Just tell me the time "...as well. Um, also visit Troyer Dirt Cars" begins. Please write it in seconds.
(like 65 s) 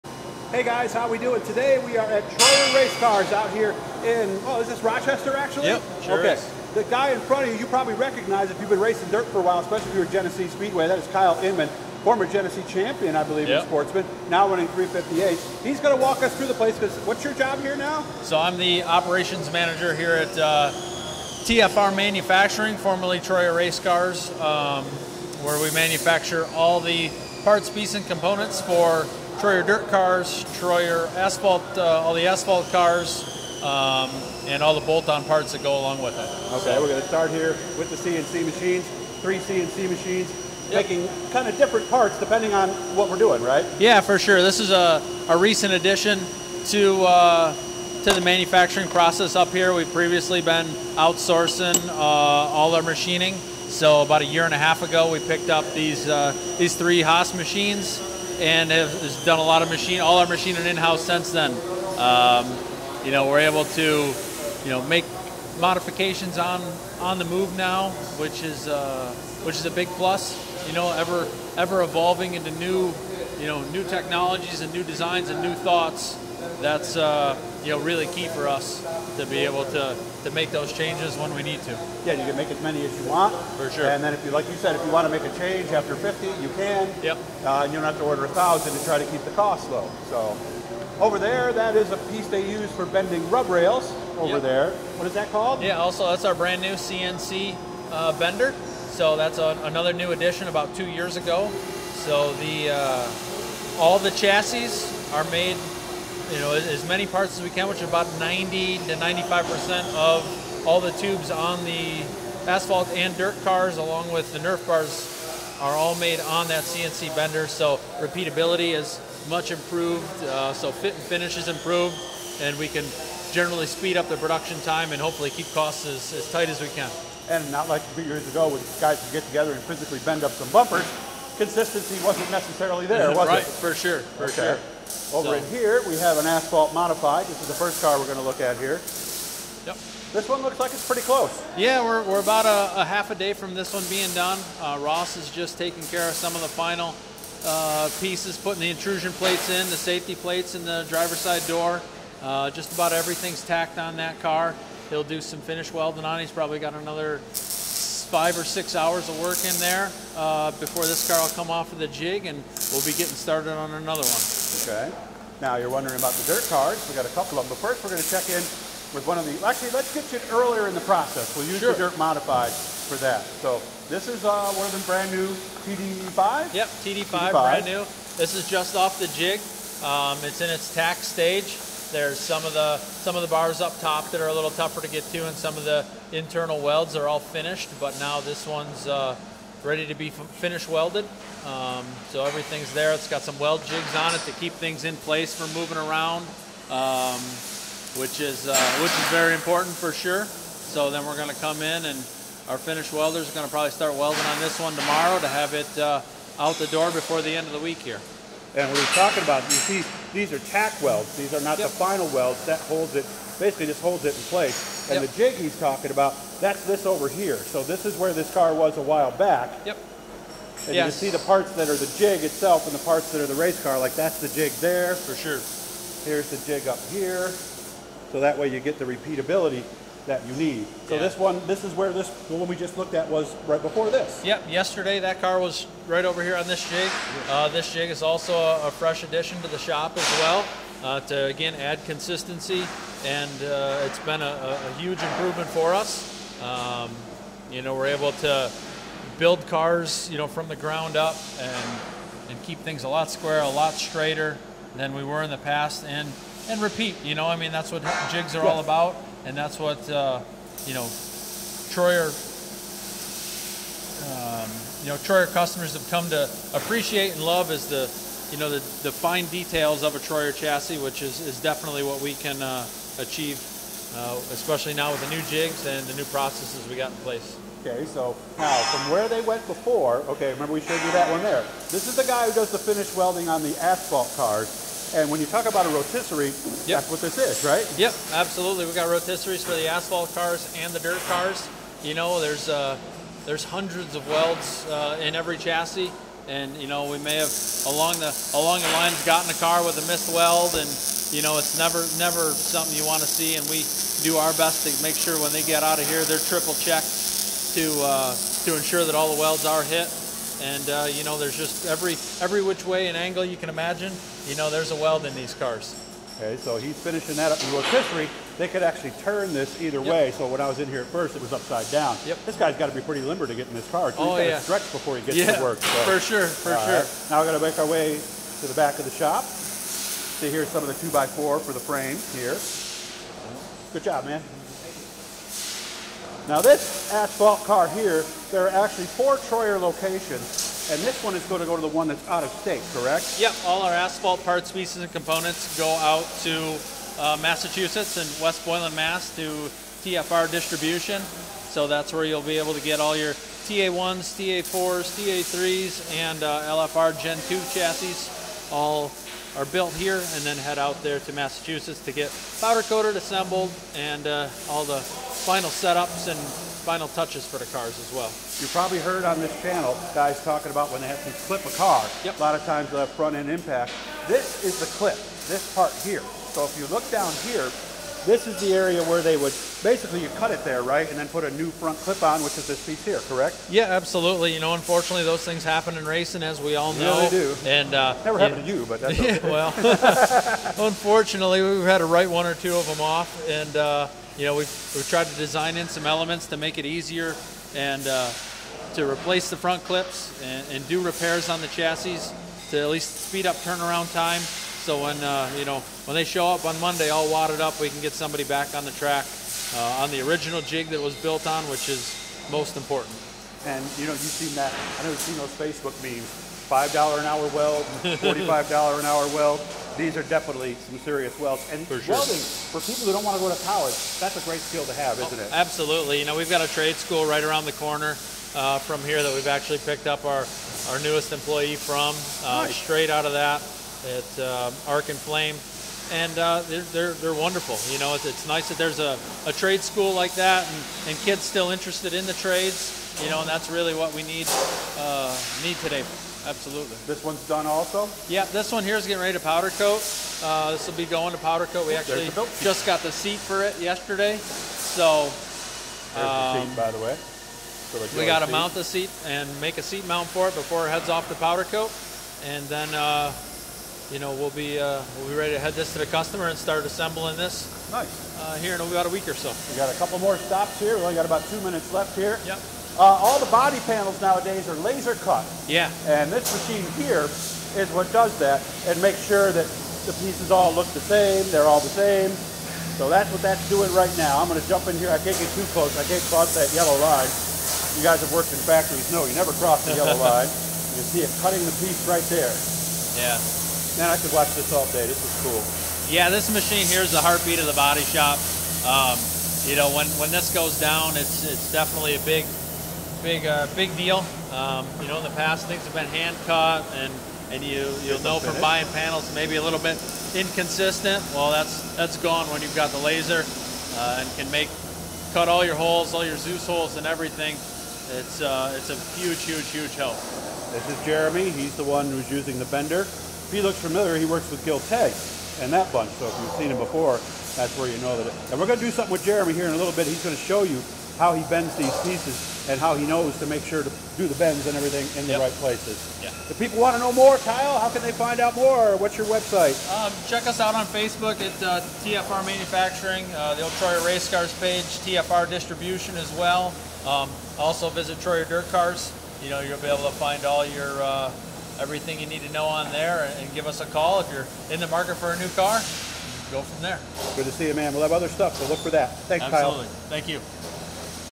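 545 s.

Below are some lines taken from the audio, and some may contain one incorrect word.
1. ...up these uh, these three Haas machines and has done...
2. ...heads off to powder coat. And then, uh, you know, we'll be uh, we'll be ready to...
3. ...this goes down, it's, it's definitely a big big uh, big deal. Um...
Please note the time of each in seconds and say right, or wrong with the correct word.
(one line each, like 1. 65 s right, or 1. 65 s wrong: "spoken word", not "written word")
1. 55 s right
2. 460 s right
3. 500 s right.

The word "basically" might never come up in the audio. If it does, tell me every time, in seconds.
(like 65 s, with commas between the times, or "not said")
213 s, 379 s.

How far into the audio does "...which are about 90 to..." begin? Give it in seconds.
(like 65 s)
107 s.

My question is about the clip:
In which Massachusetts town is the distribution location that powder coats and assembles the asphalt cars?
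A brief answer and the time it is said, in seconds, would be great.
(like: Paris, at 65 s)
West Boylston, at 348 s.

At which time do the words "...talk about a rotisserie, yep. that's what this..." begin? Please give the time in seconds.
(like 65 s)
285 s.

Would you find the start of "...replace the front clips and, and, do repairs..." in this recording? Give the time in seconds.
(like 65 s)
398 s.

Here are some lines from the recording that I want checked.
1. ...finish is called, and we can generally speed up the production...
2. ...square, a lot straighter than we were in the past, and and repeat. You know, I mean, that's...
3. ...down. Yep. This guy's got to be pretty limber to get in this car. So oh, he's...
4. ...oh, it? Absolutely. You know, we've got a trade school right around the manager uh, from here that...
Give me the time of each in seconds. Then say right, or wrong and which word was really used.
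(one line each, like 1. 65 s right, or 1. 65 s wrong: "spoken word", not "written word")
1. 121 s wrong: "improved", not "called"
2. 253 s right
3. 321 s right
4. 425 s wrong: "corner", not "manager".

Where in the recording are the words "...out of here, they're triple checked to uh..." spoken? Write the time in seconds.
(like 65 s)
305 s.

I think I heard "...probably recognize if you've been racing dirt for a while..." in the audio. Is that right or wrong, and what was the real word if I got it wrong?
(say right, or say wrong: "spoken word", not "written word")
right.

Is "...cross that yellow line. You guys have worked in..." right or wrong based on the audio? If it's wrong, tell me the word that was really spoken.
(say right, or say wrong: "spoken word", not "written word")
right.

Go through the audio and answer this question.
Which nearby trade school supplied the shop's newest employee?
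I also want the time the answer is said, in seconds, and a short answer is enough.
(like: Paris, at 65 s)
Arc and Flame, at 434 s.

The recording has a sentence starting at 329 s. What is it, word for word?
See here's some of the 2x4 for the frame here.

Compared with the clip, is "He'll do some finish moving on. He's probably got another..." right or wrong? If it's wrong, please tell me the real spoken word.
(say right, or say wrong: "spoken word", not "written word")
wrong: "welding", not "moving".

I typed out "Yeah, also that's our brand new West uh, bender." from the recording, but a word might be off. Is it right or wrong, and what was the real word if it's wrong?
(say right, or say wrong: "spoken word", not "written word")
wrong: "CNC", not "West".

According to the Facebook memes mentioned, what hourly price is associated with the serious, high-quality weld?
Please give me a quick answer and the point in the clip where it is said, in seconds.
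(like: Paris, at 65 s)
$45, at 417 s.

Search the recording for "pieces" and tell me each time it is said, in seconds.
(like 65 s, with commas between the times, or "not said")
27 s, 92 s, 147 s, 344 s, 382 s, 479 s, 491 s, 531 s.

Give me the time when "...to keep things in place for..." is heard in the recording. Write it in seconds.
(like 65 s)
194 s.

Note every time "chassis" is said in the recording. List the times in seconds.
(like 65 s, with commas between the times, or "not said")
104 s, 270 s, 295 s, 357 s, 401 s.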